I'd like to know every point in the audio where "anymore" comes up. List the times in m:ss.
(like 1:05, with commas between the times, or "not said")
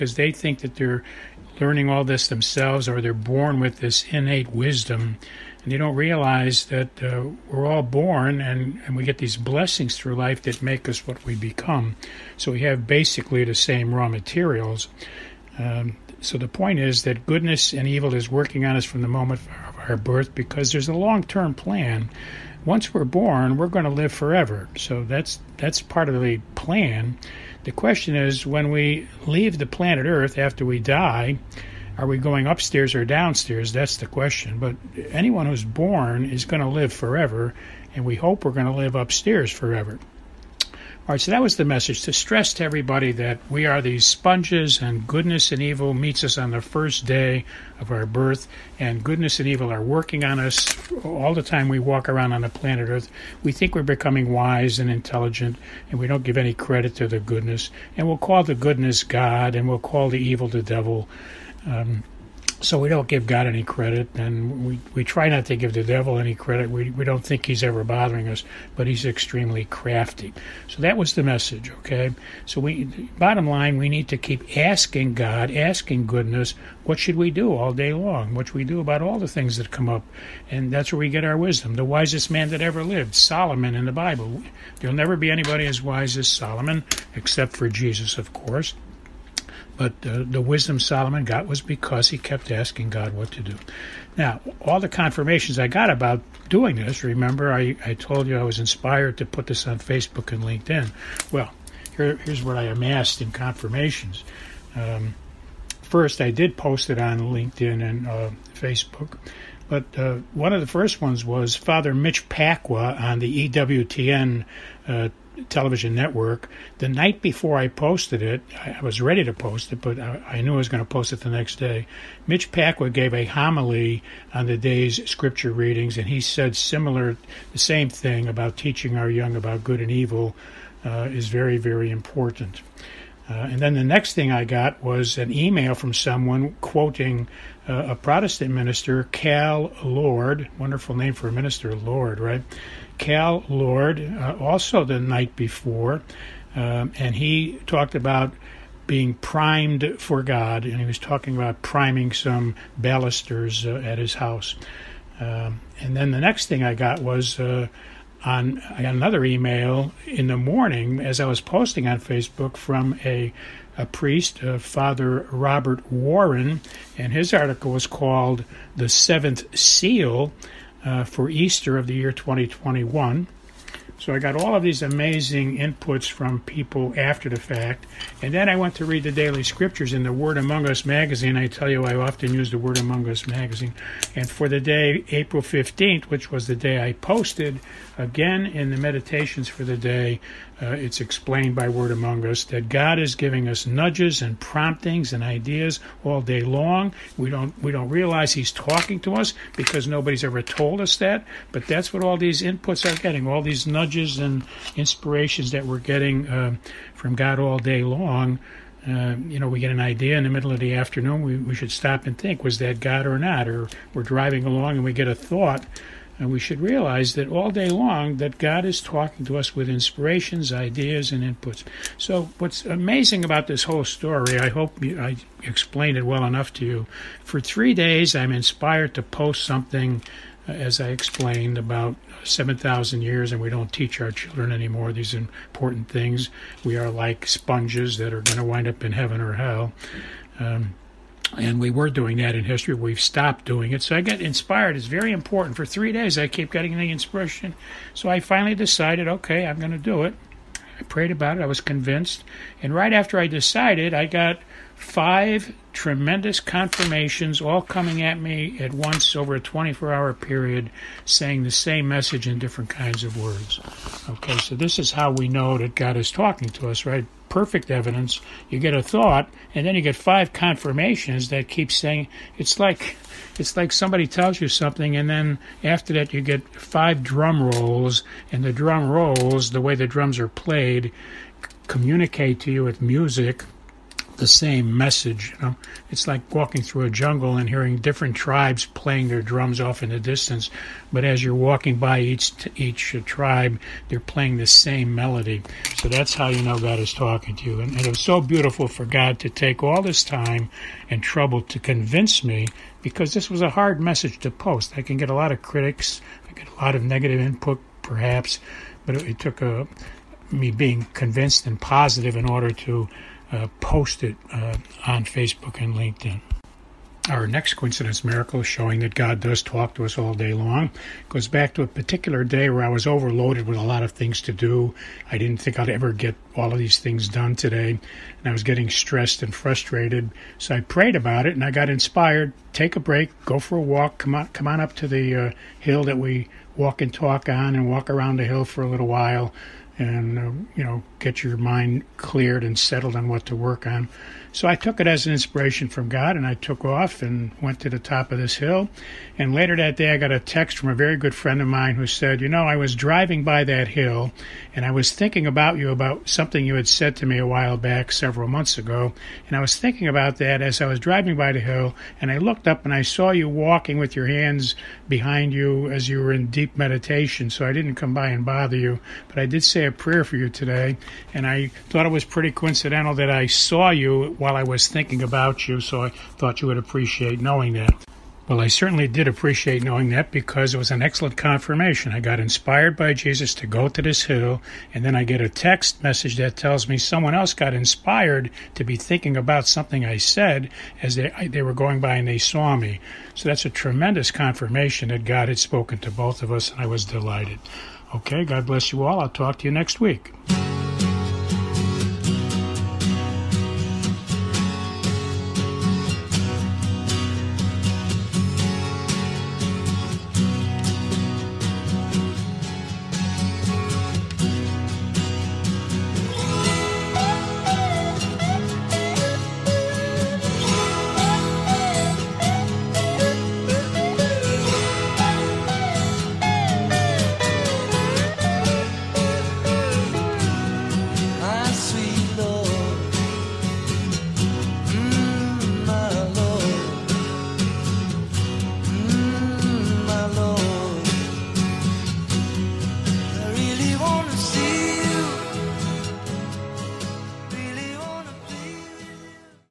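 3:54.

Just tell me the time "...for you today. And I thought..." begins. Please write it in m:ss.
6:10.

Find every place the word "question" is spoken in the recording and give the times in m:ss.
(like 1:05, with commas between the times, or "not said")
0:27, 0:34.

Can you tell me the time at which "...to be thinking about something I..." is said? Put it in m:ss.
6:28.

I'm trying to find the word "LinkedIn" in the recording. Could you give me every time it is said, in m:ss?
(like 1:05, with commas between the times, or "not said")
1:40, 1:47, 5:15.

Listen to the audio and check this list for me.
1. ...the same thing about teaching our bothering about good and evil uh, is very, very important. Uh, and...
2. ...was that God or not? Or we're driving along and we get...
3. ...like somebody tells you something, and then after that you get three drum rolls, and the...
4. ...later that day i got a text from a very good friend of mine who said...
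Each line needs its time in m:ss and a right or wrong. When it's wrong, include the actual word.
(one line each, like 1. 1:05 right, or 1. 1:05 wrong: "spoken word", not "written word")
1. 2:07 wrong: "young", not "bothering"
2. 3:32 right
3. 4:33 wrong: "five", not "three"
4. 5:49 right.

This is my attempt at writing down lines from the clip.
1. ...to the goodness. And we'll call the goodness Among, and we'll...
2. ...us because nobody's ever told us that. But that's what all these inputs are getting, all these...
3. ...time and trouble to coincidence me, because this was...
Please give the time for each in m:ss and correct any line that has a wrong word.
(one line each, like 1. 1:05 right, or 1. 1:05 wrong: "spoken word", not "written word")
1. 0:56 wrong: "God", not "Among"
2. 3:19 right
3. 5:00 wrong: "convince", not "coincidence".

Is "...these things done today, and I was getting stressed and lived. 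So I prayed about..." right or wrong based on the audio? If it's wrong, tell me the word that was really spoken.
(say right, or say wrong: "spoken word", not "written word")
wrong: "frustrated", not "lived".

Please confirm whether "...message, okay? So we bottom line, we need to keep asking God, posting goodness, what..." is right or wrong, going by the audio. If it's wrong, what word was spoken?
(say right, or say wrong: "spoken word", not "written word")
wrong: "asking", not "posting".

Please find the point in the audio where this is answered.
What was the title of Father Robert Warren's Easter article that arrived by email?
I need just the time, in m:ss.
2:48.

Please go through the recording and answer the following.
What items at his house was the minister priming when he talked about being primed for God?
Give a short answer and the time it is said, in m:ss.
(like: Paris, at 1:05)
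balusters, at 2:32.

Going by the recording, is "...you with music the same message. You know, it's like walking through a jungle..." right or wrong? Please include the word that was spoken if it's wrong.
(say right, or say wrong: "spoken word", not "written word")
right.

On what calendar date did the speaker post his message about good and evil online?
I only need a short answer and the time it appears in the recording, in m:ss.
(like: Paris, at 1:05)
April 15th, at 3:05.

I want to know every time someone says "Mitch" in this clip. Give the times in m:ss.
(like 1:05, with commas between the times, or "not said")
1:51, 2:02.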